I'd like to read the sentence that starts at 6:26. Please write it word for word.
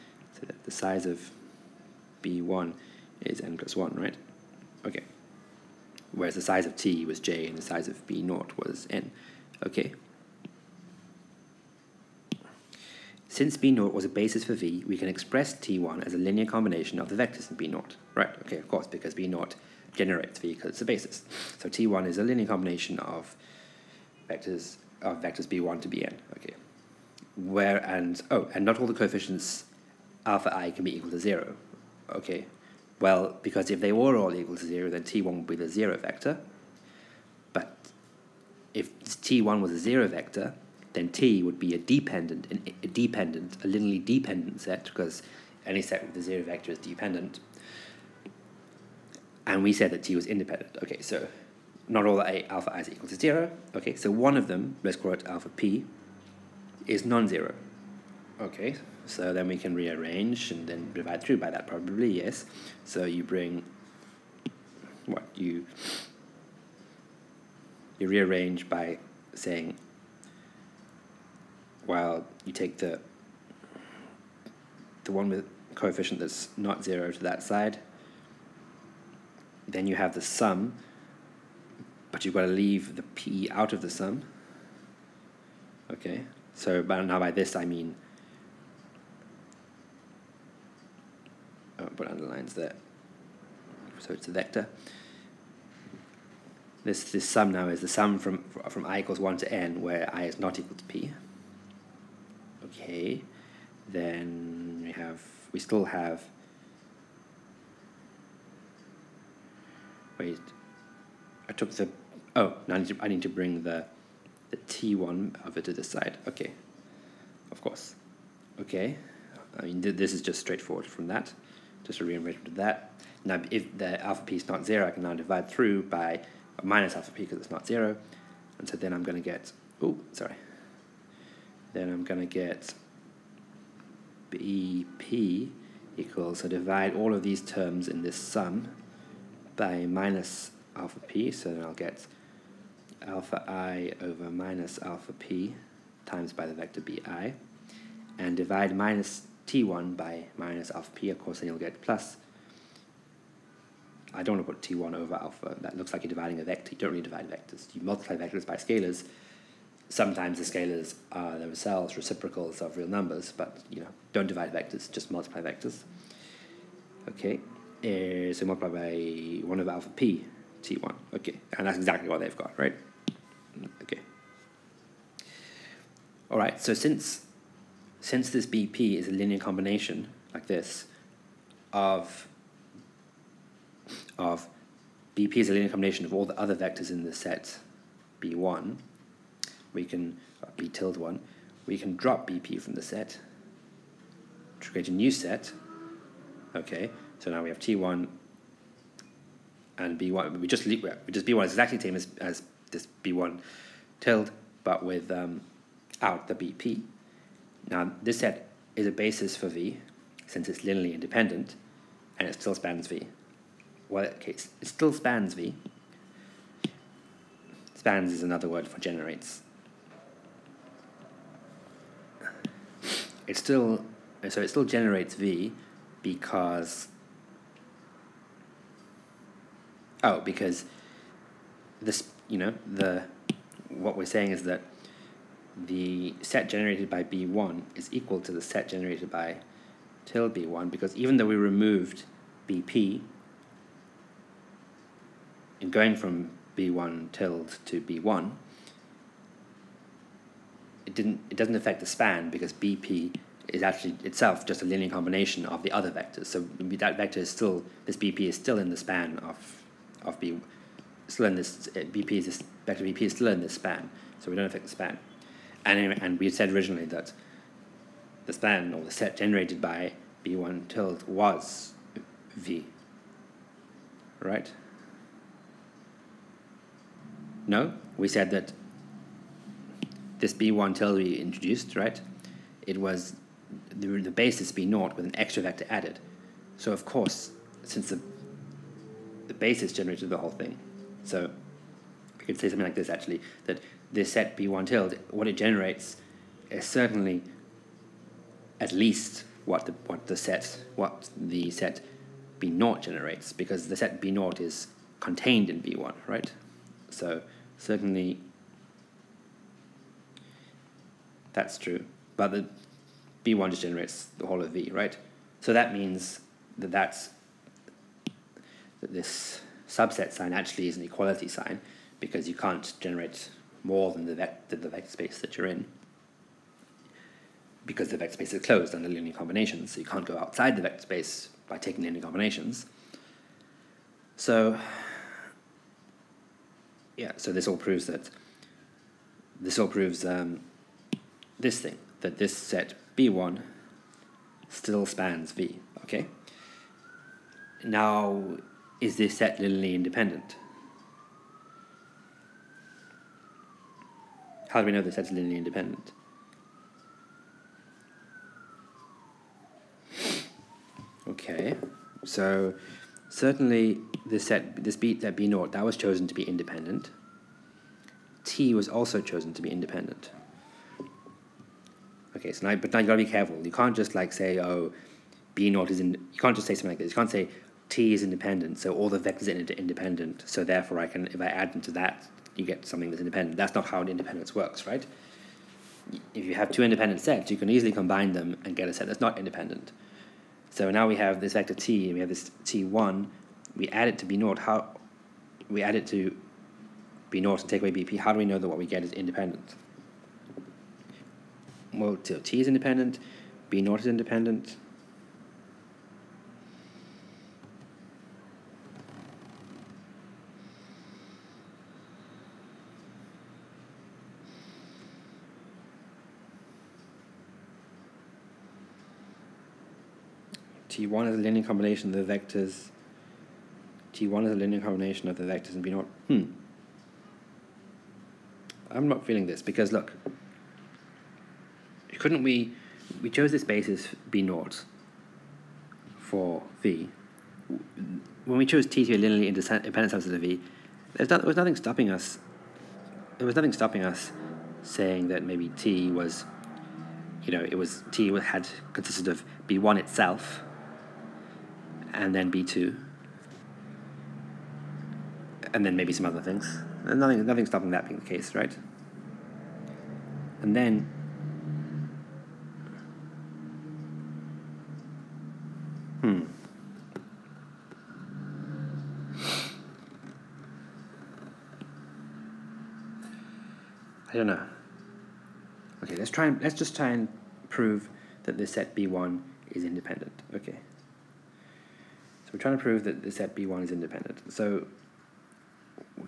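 If you have two independent sets, you can easily combine them and get a set that's not independent.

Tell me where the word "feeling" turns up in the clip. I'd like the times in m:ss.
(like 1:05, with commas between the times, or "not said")
7:09.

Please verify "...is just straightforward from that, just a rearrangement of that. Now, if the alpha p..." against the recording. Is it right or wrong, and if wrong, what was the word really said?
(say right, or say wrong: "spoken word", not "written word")
right.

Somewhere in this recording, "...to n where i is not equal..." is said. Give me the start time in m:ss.
1:39.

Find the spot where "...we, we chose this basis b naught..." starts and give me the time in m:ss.
7:12.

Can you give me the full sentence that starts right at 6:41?
well, so T is independent, B naught is independent.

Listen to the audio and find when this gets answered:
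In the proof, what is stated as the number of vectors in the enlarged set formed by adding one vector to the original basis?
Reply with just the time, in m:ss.
0:03.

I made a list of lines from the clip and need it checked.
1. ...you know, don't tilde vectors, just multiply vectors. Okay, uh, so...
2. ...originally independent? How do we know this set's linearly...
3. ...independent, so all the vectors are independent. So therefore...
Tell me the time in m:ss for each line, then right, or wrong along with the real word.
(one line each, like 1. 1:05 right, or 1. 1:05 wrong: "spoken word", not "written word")
1. 2:43 wrong: "divide", not "tilde"
2. 5:49 wrong: "linearly", not "originally"
3. 6:18 right.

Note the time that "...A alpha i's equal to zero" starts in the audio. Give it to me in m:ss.
0:52.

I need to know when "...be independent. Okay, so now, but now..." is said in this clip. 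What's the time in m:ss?
6:09.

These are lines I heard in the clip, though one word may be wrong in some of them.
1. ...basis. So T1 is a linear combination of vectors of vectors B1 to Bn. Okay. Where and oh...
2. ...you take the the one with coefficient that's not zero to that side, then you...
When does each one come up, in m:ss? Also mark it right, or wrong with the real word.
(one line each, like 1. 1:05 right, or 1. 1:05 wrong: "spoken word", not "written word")
1. 0:20 right
2. 1:12 right.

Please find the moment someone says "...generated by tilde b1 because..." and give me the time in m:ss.
3:58.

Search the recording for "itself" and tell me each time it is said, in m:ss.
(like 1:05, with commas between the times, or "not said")
4:14, 7:29.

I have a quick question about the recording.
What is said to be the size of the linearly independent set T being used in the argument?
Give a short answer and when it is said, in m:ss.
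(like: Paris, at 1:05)
j, at 0:07.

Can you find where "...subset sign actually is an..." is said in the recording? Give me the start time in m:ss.
5:19.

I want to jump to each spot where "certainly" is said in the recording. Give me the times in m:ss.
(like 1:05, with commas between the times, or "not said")
4:56, 5:07, 6:03.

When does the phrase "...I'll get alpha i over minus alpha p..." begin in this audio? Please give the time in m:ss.
2:21.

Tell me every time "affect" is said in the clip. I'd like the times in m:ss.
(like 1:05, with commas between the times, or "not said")
4:11, 4:24.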